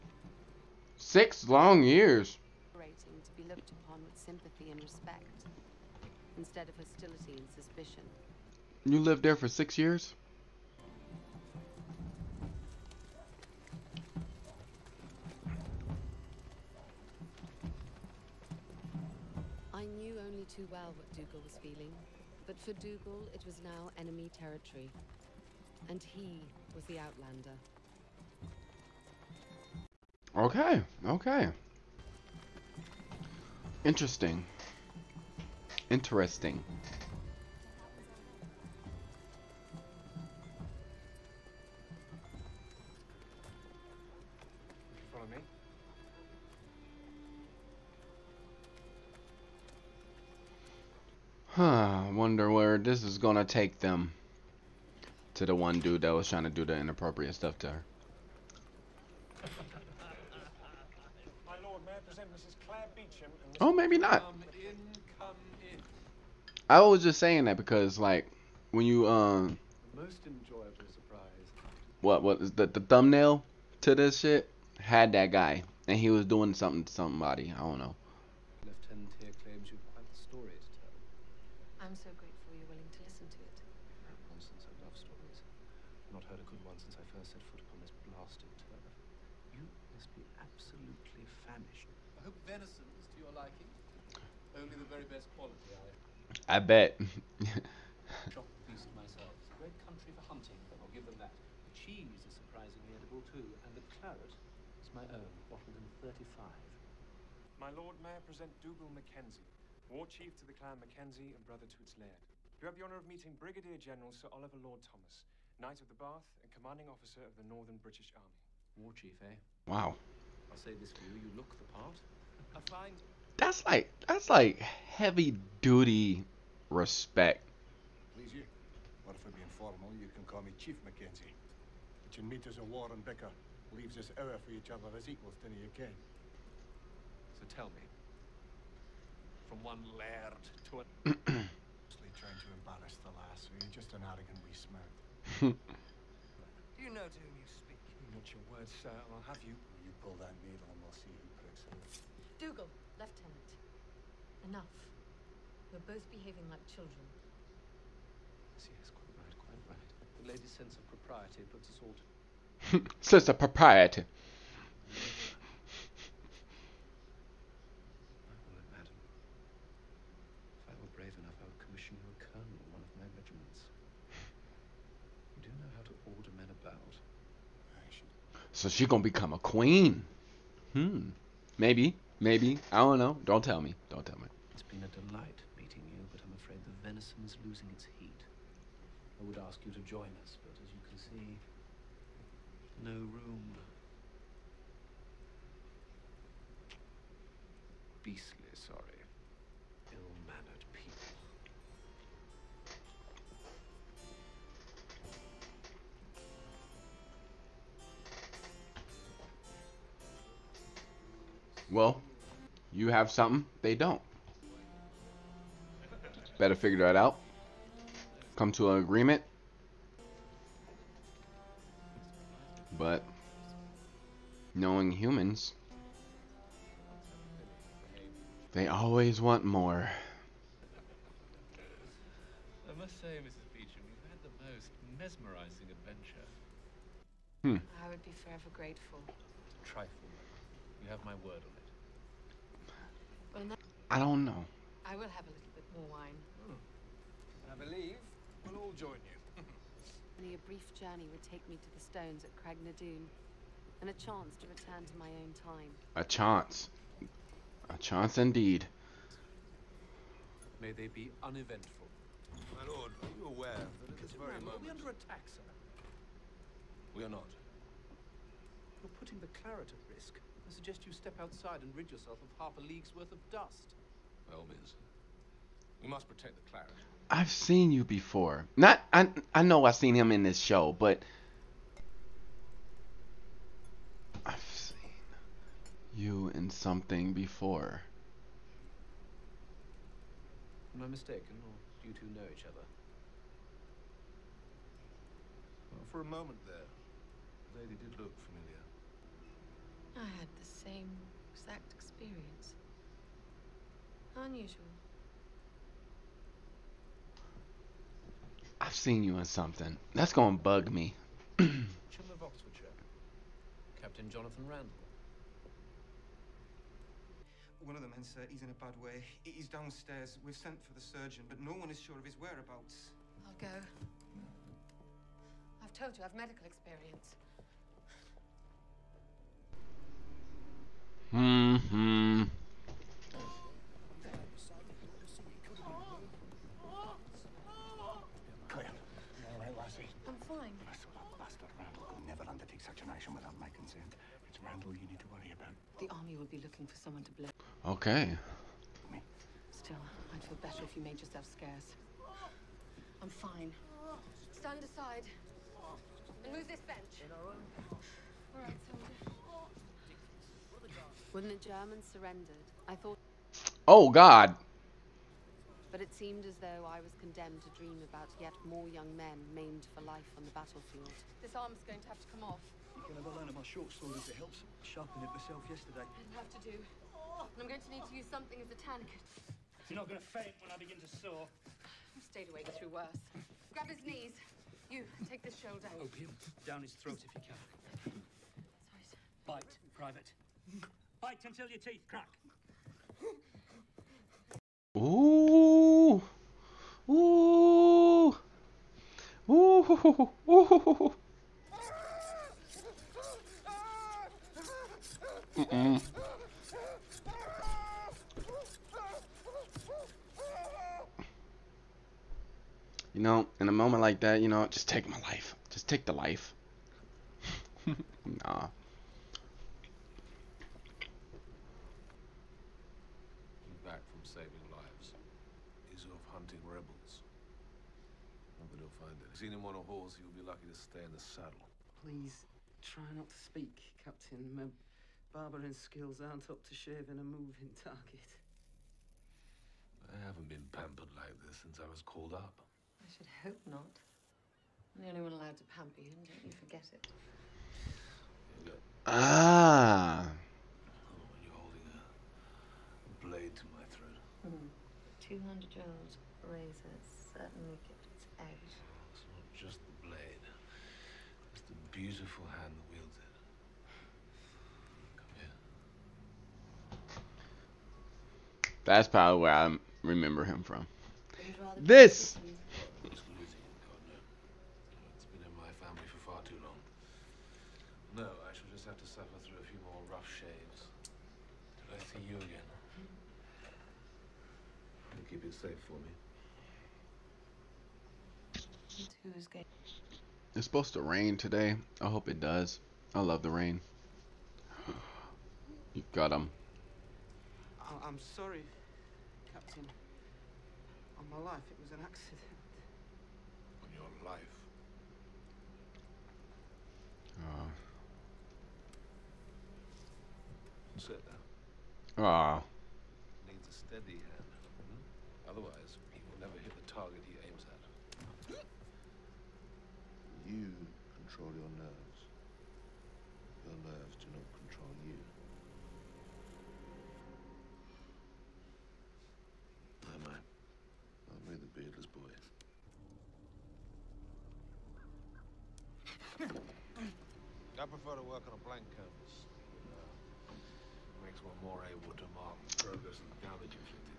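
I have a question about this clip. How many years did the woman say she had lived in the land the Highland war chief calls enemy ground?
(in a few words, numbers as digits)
6.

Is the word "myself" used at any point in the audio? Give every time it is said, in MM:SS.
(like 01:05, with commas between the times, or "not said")
01:38, 06:15.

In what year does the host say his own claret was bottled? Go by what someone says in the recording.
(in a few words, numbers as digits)
1735.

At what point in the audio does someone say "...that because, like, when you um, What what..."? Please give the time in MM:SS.
01:07.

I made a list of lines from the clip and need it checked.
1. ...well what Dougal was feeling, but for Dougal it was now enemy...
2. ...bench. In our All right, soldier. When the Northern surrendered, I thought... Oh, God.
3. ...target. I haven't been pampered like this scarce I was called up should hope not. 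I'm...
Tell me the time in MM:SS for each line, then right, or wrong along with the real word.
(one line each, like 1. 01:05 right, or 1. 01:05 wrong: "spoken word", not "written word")
1. 00:20 right
2. 05:56 wrong: "Germans", not "Northern"
3. 07:17 wrong: "since", not "scarce".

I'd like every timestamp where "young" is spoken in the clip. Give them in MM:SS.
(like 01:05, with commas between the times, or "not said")
06:08.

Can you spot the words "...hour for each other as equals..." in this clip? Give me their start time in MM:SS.
02:14.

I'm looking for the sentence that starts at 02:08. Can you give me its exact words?
Please you, or if it be informal, you can call me Chief Mackenzie.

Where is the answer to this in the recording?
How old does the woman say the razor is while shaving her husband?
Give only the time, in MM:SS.
07:35.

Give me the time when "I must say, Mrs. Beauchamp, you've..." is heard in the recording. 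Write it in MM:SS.
03:52.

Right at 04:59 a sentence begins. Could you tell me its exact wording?
I had the same exact experience.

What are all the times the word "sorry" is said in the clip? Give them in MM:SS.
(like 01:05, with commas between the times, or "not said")
03:18, 06:28, 08:17.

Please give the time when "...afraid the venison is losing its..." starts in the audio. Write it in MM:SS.
03:06.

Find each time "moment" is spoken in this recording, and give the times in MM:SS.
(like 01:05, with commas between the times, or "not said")
04:24, 04:56, 06:53.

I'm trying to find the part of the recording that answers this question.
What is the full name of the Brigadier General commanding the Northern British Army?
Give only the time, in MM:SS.
01:54.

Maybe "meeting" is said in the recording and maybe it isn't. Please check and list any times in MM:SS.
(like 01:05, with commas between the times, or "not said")
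01:53, 03:05.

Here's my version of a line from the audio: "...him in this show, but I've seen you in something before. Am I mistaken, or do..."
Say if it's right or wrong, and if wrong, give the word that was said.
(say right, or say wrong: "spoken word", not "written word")
right.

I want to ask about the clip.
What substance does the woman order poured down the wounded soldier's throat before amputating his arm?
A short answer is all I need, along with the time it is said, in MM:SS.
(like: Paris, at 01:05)
Opium, at 06:25.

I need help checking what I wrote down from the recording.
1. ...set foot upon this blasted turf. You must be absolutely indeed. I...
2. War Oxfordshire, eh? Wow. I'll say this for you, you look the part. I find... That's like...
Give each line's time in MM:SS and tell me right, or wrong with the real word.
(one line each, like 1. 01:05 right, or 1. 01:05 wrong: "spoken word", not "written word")
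1. 01:27 wrong: "famished", not "indeed"
2. 01:58 wrong: "Chief", not "Oxfordshire".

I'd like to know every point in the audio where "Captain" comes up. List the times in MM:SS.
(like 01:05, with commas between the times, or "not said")
05:13, 07:13, 08:19.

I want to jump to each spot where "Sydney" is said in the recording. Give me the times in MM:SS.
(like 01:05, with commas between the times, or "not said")
not said.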